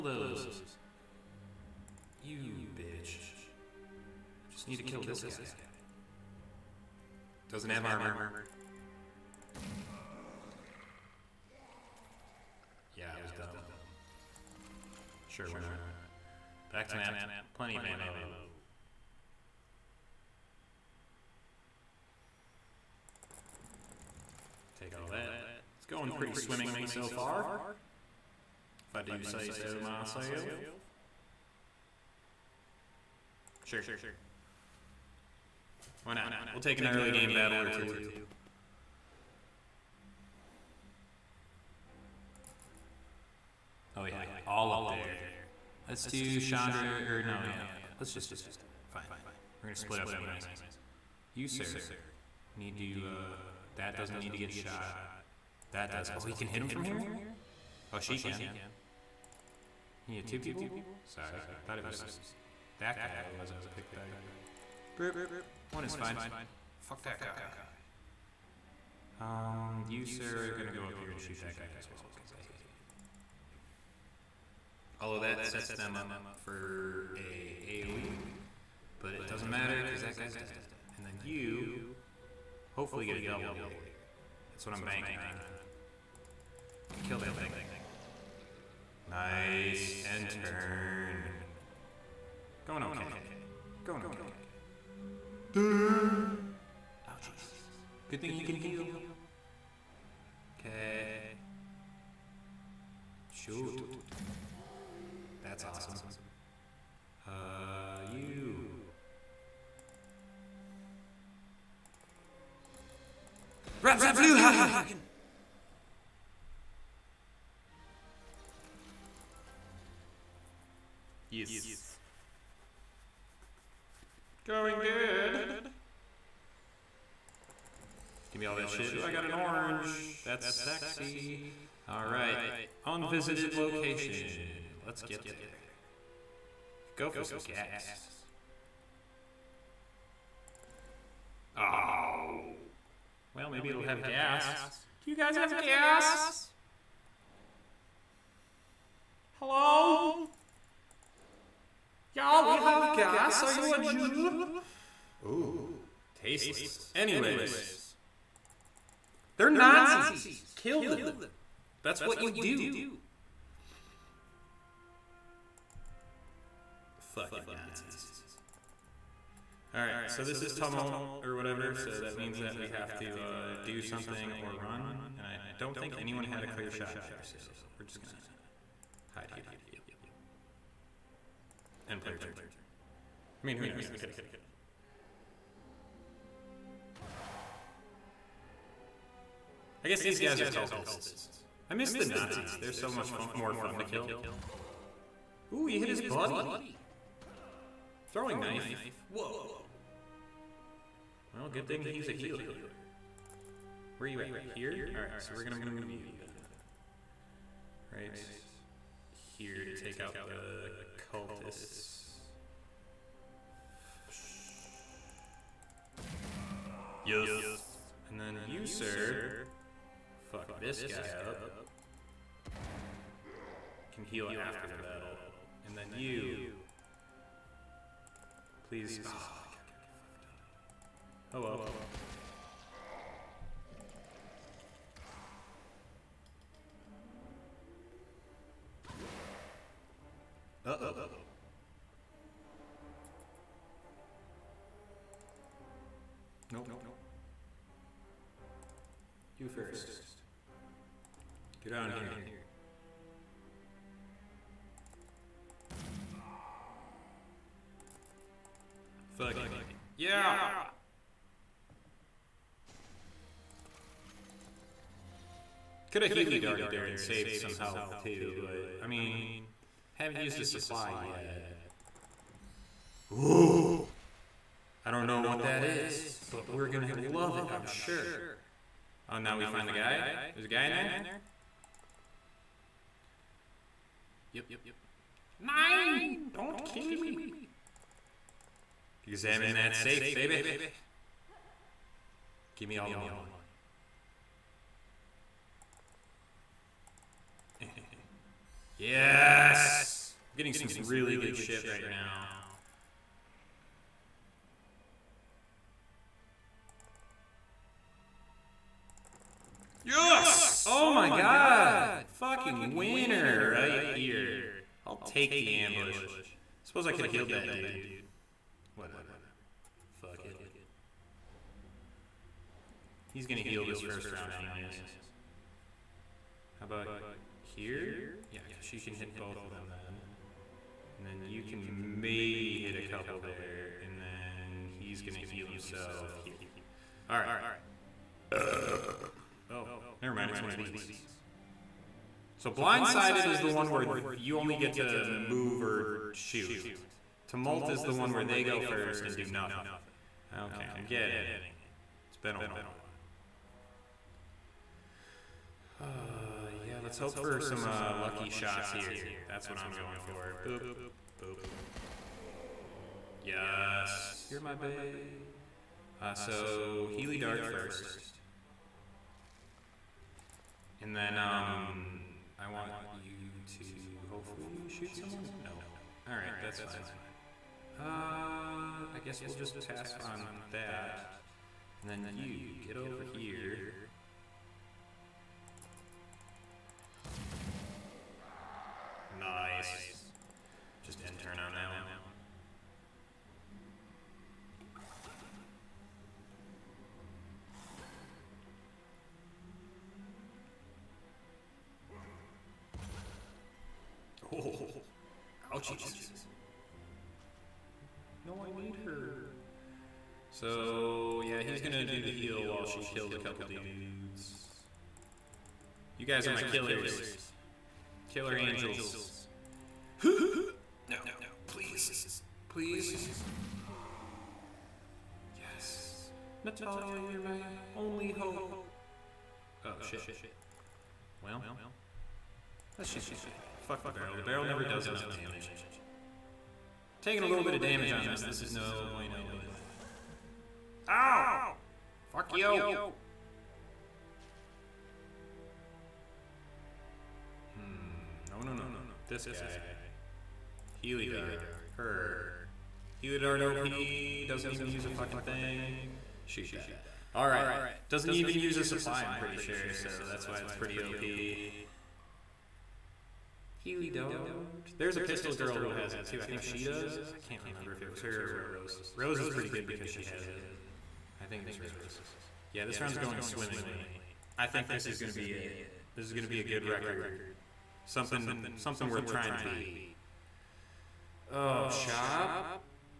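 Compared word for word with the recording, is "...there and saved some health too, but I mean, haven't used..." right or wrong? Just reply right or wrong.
right.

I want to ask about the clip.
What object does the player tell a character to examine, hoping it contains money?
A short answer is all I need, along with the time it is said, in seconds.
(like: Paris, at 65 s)
Safe, at 289 s.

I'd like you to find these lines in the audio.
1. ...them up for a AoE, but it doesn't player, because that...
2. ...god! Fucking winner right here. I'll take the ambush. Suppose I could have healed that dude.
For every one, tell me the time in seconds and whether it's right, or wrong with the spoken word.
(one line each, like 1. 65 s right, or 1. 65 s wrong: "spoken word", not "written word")
1. 75 s wrong: "matter", not "player"
2. 311 s right.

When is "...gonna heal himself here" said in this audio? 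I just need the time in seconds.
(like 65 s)
335 s.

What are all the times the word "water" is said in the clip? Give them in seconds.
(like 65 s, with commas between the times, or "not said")
not said.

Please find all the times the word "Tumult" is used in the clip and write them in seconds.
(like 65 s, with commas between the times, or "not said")
170 s, 347 s.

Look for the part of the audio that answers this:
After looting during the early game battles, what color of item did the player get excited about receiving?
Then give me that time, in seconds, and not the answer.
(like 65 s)
129 s.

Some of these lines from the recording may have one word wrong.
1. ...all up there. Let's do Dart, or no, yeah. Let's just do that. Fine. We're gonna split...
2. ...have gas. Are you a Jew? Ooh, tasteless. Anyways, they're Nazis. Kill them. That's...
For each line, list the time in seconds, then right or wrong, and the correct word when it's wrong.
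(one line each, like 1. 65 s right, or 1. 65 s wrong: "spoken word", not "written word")
1. 44 s wrong: "Chandra", not "Dart"
2. 152 s right.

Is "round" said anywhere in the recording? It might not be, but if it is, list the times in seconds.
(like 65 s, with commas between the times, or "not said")
324 s, 472 s.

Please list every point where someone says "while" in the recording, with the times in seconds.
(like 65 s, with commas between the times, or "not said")
352 s, 412 s.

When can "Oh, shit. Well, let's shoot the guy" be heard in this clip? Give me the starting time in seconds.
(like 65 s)
429 s.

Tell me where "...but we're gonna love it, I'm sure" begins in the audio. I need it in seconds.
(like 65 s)
276 s.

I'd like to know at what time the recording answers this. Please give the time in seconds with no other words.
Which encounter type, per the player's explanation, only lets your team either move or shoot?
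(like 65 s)
342 s.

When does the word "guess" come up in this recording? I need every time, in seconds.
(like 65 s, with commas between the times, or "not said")
189 s, 379 s.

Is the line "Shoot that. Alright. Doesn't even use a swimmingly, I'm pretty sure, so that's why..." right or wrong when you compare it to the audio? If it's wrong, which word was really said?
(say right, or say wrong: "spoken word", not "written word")
wrong: "supply", not "swimmingly".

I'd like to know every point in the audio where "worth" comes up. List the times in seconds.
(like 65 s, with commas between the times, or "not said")
478 s.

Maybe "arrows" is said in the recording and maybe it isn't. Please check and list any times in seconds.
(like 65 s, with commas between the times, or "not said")
not said.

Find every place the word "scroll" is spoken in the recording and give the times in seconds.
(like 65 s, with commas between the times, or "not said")
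not said.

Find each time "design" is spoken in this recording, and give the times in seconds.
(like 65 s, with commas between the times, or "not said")
not said.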